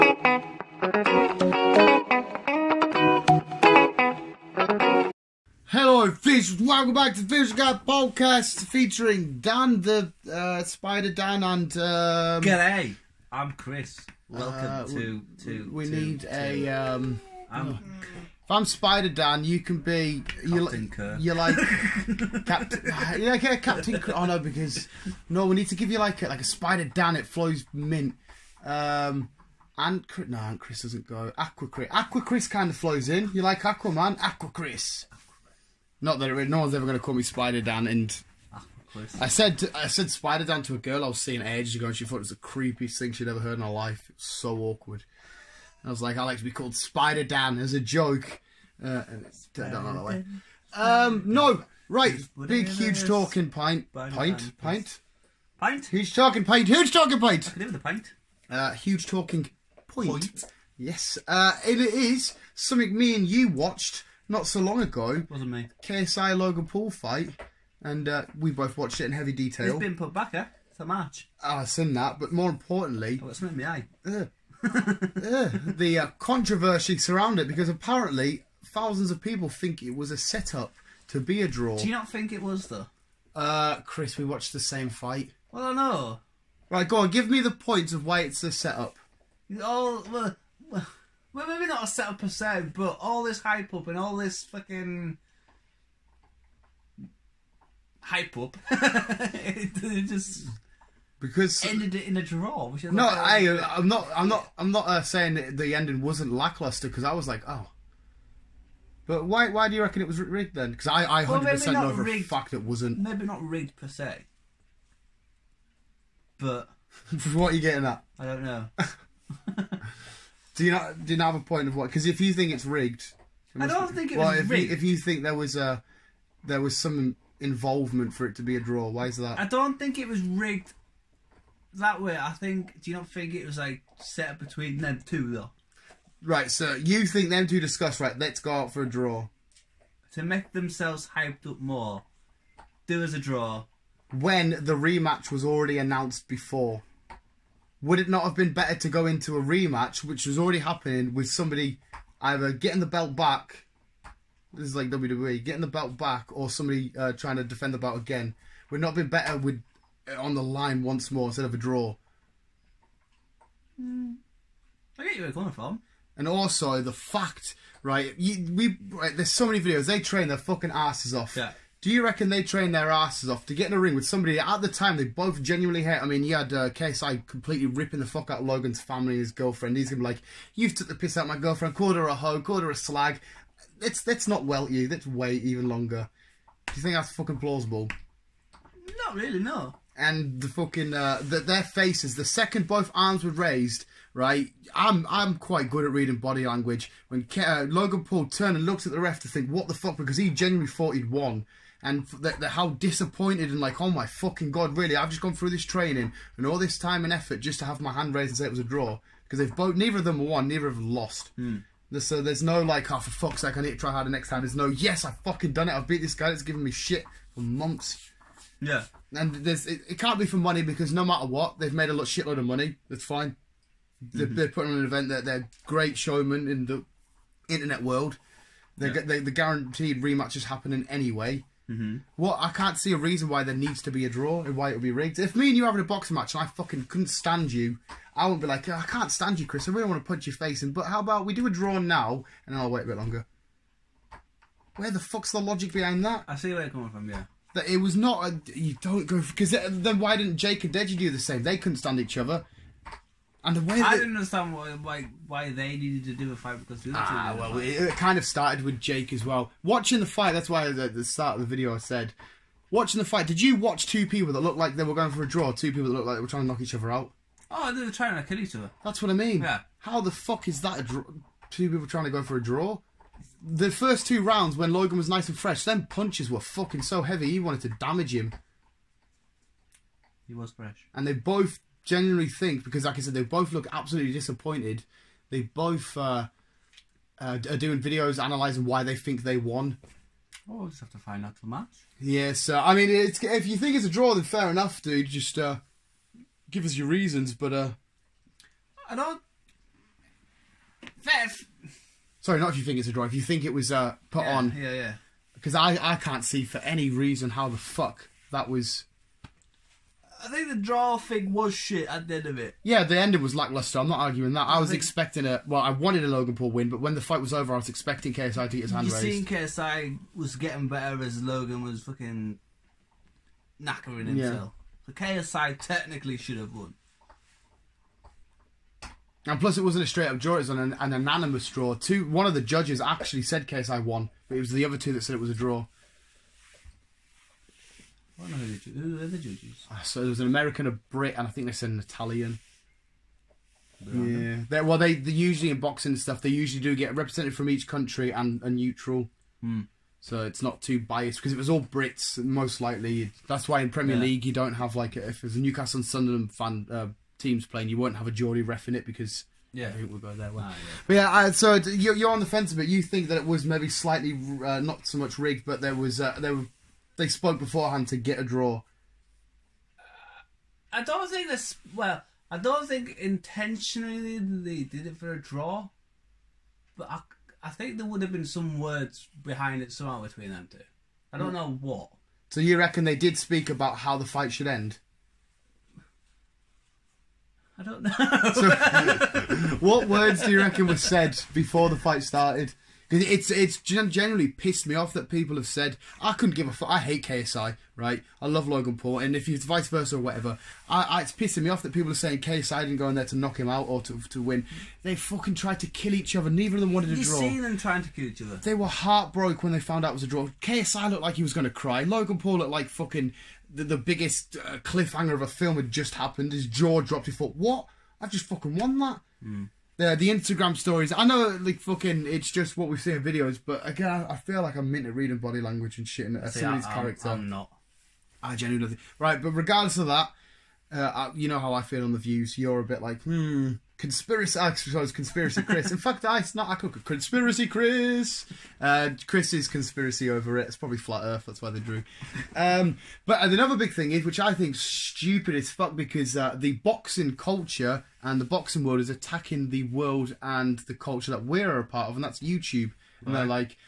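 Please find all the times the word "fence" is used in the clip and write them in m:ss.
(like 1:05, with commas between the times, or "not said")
6:02.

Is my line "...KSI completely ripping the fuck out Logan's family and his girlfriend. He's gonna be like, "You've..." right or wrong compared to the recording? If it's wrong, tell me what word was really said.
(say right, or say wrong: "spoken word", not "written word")
right.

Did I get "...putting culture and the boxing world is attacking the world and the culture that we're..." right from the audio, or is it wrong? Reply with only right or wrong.
wrong.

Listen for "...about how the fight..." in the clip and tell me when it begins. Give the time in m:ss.
6:23.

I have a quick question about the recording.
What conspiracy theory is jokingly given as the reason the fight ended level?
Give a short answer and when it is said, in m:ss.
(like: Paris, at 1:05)
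Flat Earth, at 7:20.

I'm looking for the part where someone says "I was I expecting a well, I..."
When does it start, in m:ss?
5:14.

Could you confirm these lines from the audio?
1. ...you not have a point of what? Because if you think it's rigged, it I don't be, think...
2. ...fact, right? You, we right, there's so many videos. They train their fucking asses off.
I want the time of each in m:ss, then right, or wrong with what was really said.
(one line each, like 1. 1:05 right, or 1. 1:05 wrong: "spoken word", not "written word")
1. 2:01 right
2. 2:46 right.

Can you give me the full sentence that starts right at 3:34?
There's no, yes, I've fucking done it.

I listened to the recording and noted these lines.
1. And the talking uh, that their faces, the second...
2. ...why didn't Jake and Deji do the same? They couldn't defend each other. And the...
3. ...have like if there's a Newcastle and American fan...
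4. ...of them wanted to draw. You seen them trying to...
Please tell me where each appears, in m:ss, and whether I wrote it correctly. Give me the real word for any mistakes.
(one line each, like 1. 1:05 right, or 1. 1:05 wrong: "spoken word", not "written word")
1. 3:09 wrong: "fucking", not "talking"
2. 4:10 wrong: "stand", not "defend"
3. 5:54 wrong: "Sunderland", not "American"
4. 6:46 right.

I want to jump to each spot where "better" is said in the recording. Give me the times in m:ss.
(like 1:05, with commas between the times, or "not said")
2:28, 2:39, 5:20.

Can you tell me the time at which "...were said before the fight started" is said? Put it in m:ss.
6:30.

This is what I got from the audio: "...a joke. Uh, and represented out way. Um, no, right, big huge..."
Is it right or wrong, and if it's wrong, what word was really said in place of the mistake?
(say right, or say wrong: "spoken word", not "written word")
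wrong: "turned", not "represented".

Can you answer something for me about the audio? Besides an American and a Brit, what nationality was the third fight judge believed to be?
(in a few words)
Italian.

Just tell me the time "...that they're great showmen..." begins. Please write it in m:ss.
3:45.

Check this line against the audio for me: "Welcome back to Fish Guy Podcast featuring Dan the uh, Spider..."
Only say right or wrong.
right.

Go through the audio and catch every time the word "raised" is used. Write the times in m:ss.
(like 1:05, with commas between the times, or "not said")
3:13, 3:28, 5:18.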